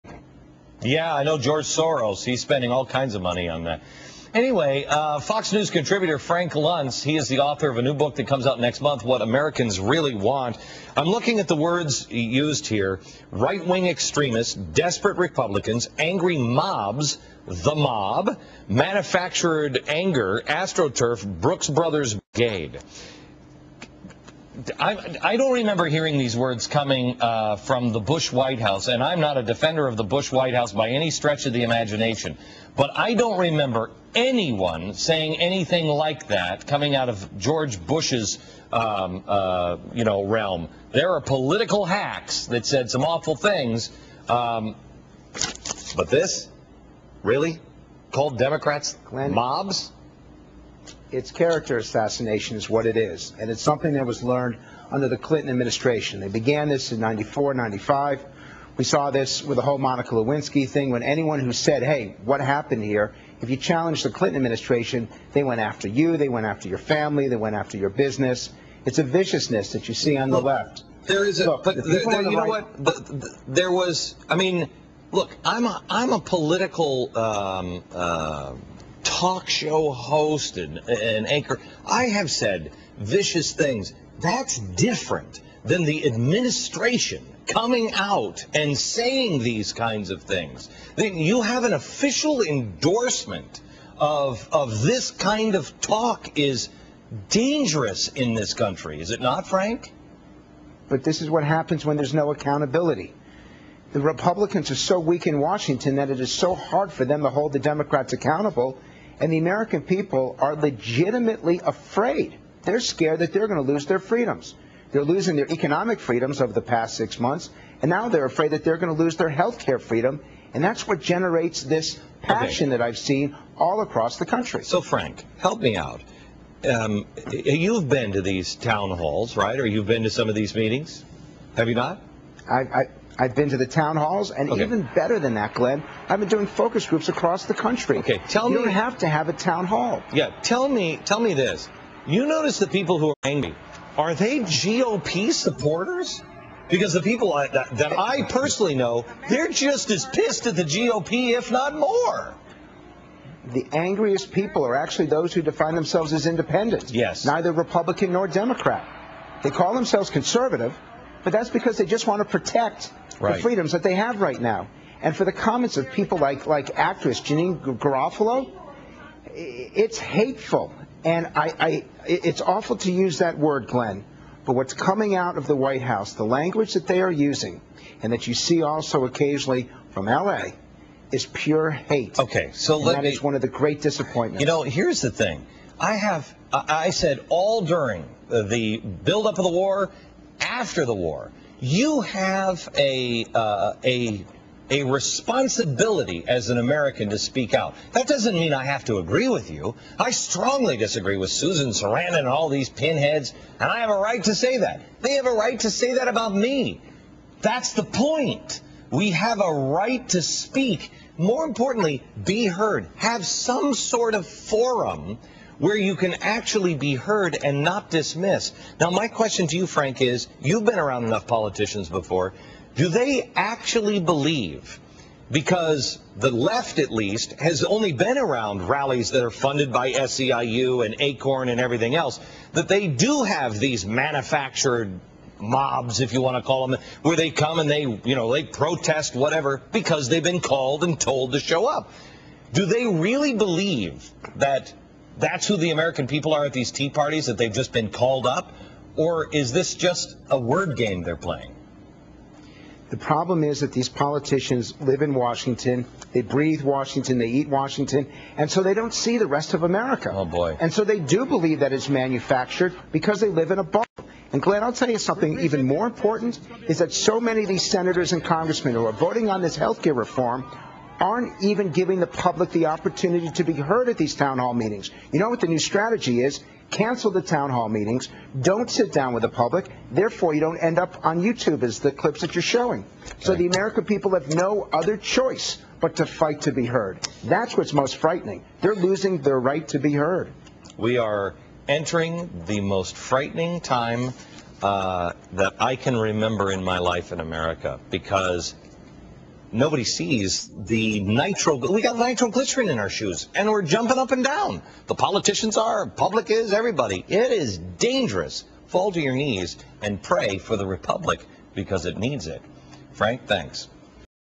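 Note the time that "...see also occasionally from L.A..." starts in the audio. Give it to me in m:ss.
2:58.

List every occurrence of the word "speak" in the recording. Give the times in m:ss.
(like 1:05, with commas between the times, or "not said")
3:17, 3:30.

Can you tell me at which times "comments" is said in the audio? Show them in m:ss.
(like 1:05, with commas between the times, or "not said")
2:45.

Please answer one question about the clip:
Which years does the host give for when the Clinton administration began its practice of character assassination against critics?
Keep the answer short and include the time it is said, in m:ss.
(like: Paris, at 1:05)
94, 95, at 0:57.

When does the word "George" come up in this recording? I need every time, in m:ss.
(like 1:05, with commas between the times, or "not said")
0:01, 0:37.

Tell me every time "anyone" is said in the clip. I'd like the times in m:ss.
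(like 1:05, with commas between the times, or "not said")
0:34, 1:01.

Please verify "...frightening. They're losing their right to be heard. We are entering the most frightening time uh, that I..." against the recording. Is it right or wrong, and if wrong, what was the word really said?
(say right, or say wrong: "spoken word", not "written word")
right.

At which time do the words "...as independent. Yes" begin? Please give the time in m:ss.
2:36.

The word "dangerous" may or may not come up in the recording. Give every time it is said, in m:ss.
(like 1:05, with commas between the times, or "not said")
1:37, 5:07.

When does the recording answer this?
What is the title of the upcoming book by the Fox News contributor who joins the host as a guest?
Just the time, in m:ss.
0:09.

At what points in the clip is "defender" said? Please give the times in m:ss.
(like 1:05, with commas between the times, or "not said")
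0:29.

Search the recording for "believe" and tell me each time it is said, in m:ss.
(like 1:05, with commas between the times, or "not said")
3:43, 4:03, 4:21.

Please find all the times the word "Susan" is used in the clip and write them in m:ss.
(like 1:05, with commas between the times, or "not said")
3:21.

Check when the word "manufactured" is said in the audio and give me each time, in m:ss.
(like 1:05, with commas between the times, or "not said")
0:18, 3:53, 4:21.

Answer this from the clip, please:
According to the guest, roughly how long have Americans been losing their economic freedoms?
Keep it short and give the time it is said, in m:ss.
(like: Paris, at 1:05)
six months, at 1:56.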